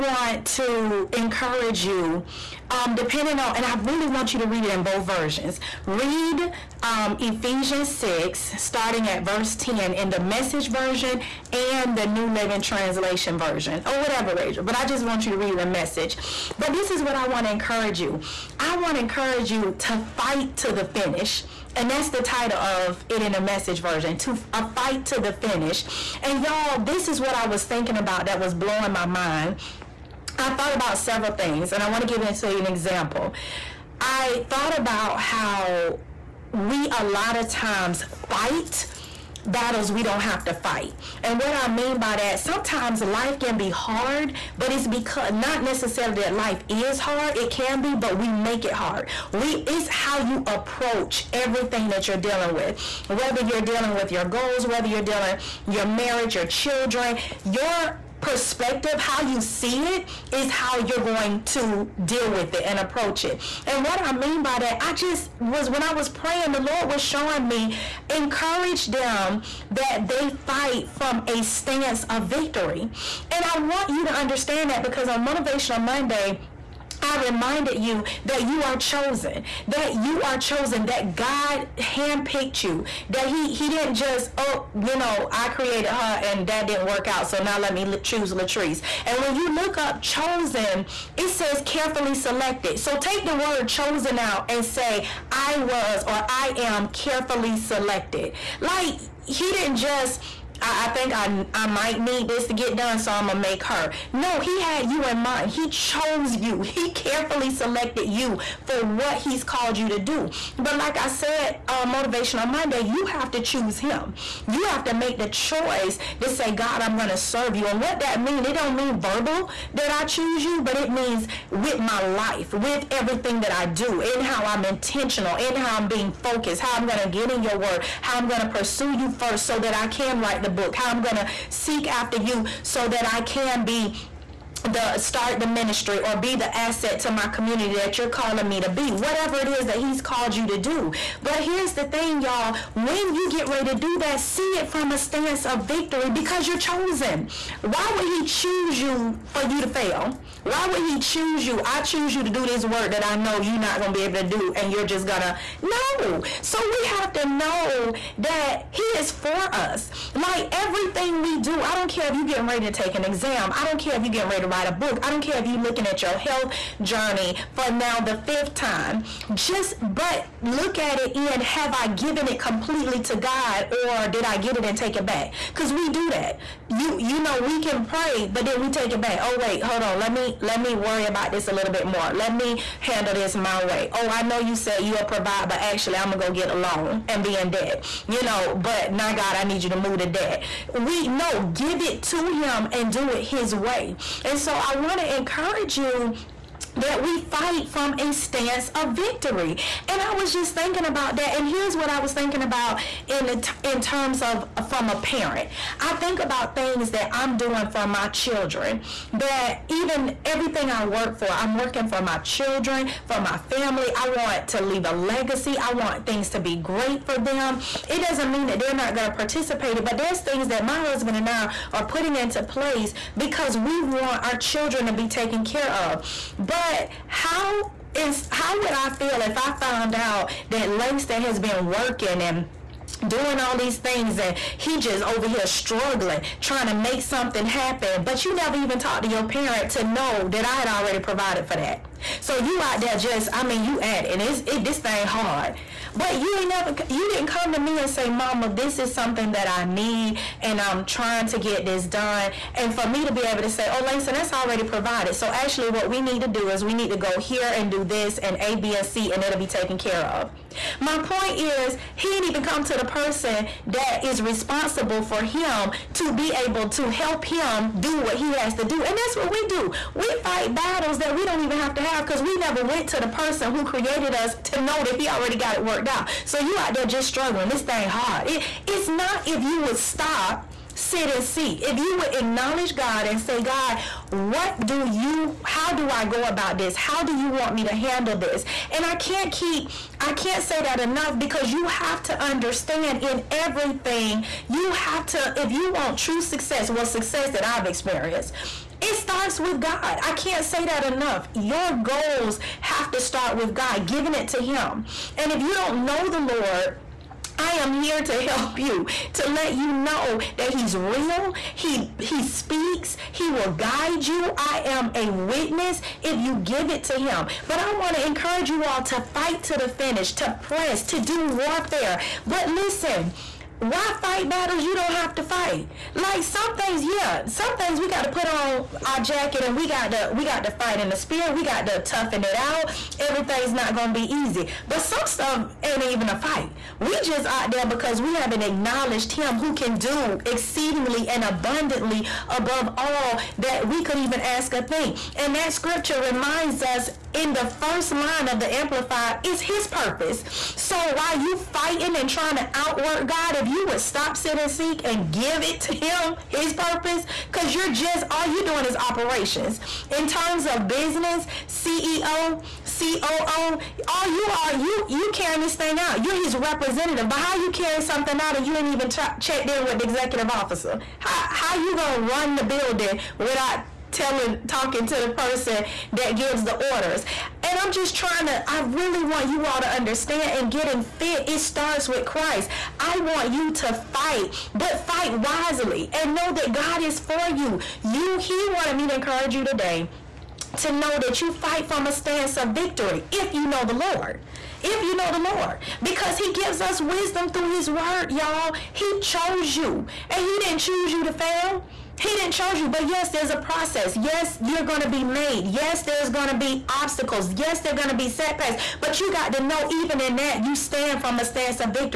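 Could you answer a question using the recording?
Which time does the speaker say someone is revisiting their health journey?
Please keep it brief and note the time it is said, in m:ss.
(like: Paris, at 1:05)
fifth, at 2:48.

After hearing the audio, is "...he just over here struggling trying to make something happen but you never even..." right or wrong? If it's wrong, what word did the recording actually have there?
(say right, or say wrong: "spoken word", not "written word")
right.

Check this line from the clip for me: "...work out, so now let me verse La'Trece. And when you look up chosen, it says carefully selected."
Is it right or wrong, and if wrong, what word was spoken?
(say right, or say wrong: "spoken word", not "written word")
wrong: "choose", not "verse".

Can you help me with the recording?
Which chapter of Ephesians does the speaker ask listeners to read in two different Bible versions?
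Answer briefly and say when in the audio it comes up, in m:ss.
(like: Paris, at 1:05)
Ephesians 6, at 0:07.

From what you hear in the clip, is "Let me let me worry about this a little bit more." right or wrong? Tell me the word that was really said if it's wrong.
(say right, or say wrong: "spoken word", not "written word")
right.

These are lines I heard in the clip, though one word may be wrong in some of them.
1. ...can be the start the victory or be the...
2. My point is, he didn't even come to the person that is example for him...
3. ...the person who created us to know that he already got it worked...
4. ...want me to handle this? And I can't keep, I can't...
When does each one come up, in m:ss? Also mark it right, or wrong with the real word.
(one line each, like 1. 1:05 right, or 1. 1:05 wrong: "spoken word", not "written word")
1. 2:13 wrong: "ministry", not "victory"
2. 4:20 wrong: "responsible", not "example"
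3. 4:32 right
4. 4:47 right.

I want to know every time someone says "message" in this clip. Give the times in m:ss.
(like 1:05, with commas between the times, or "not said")
0:10, 0:15, 0:23.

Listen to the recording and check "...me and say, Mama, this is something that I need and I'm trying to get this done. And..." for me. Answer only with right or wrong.
right.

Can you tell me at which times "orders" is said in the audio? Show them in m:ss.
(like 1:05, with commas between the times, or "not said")
6:16.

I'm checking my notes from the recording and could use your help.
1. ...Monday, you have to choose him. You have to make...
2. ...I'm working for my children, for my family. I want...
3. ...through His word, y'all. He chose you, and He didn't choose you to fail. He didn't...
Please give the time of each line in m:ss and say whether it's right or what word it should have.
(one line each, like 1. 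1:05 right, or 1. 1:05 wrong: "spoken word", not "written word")
1. 1:52 right
2. 3:31 right
3. 6:37 right.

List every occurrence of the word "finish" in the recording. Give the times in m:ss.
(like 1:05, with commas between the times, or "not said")
0:20, 0:25, 5:19.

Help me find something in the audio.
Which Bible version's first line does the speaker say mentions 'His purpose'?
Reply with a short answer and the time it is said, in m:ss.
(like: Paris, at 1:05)
Amplified, at 5:48.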